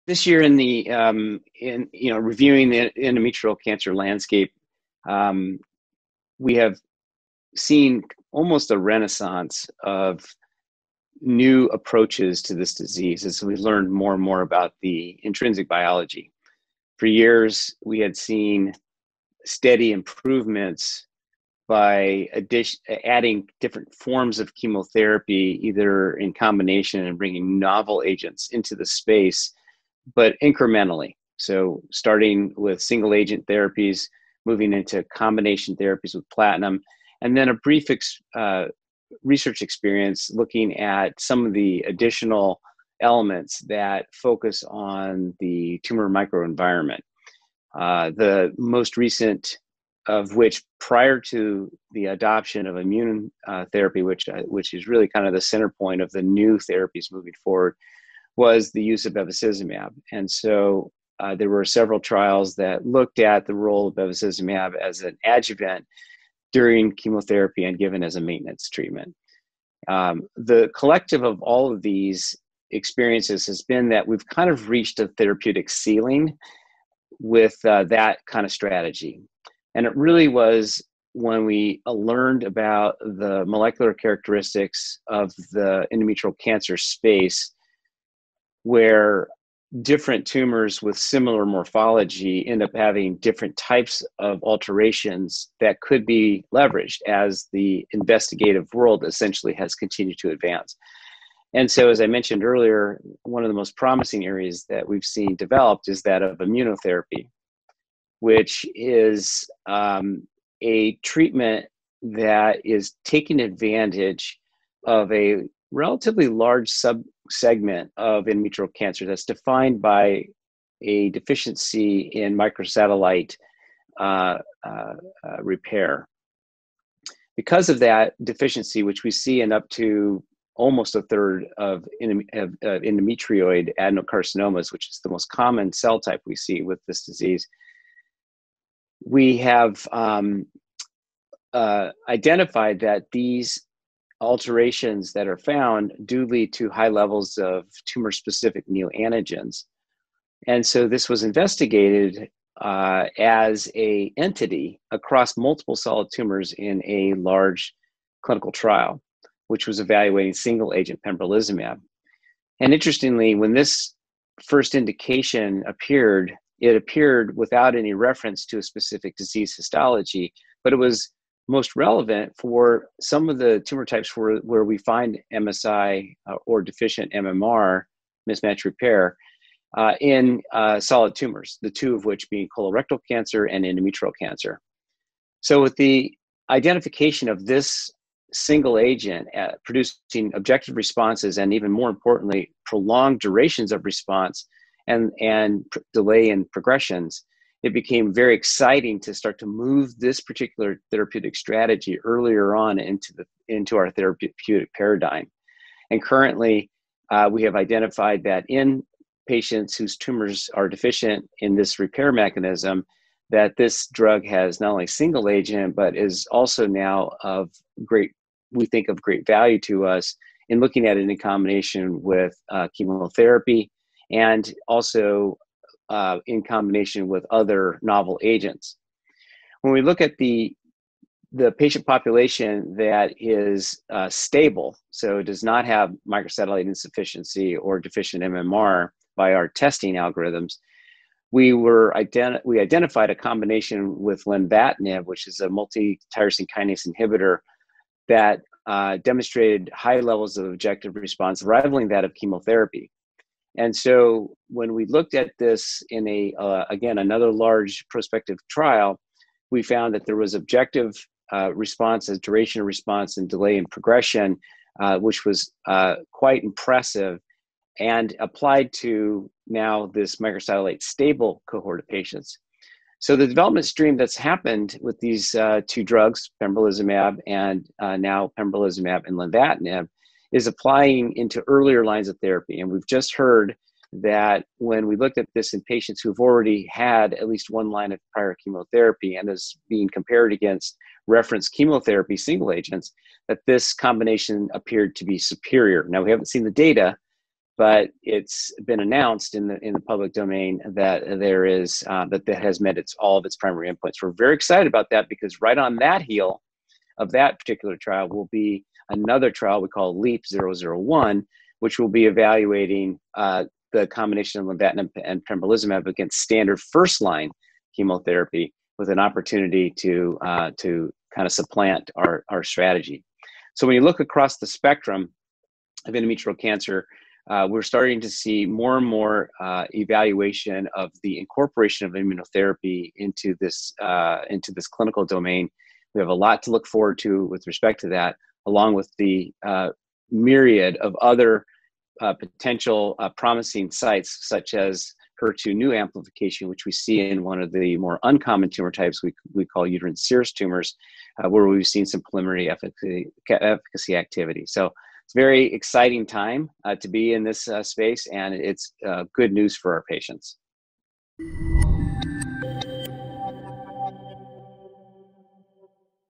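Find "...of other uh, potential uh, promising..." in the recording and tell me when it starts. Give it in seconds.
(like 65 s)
340 s.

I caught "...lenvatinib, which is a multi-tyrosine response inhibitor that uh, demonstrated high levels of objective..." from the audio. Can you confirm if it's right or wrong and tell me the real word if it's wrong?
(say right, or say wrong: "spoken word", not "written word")
wrong: "kinase", not "response".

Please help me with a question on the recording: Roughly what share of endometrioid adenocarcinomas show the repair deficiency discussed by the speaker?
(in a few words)
almost a third.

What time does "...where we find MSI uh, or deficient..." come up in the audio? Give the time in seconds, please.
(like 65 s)
174 s.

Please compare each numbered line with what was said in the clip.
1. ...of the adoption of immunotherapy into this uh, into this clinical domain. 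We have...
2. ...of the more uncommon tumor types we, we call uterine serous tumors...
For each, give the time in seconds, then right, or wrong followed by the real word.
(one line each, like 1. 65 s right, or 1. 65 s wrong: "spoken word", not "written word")
1. 330 s wrong: "incorporation", not "adoption"
2. 347 s right.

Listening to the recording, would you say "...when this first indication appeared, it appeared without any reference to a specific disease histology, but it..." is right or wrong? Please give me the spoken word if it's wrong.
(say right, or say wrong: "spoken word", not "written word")
right.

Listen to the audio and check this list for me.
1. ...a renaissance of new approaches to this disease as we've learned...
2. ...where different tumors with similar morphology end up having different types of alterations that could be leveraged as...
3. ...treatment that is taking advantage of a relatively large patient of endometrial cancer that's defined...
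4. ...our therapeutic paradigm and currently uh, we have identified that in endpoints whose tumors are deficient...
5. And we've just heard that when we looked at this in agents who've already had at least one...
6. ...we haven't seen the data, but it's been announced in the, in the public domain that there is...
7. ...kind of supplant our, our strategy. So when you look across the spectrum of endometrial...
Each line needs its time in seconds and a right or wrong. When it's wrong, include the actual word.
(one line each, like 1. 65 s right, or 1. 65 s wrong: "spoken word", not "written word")
1. 8 s right
2. 88 s right
3. 111 s wrong: "subsegment", not "patient"
4. 203 s wrong: "patients", not "endpoints"
5. 282 s wrong: "patients", not "agents"
6. 296 s right
7. 321 s right.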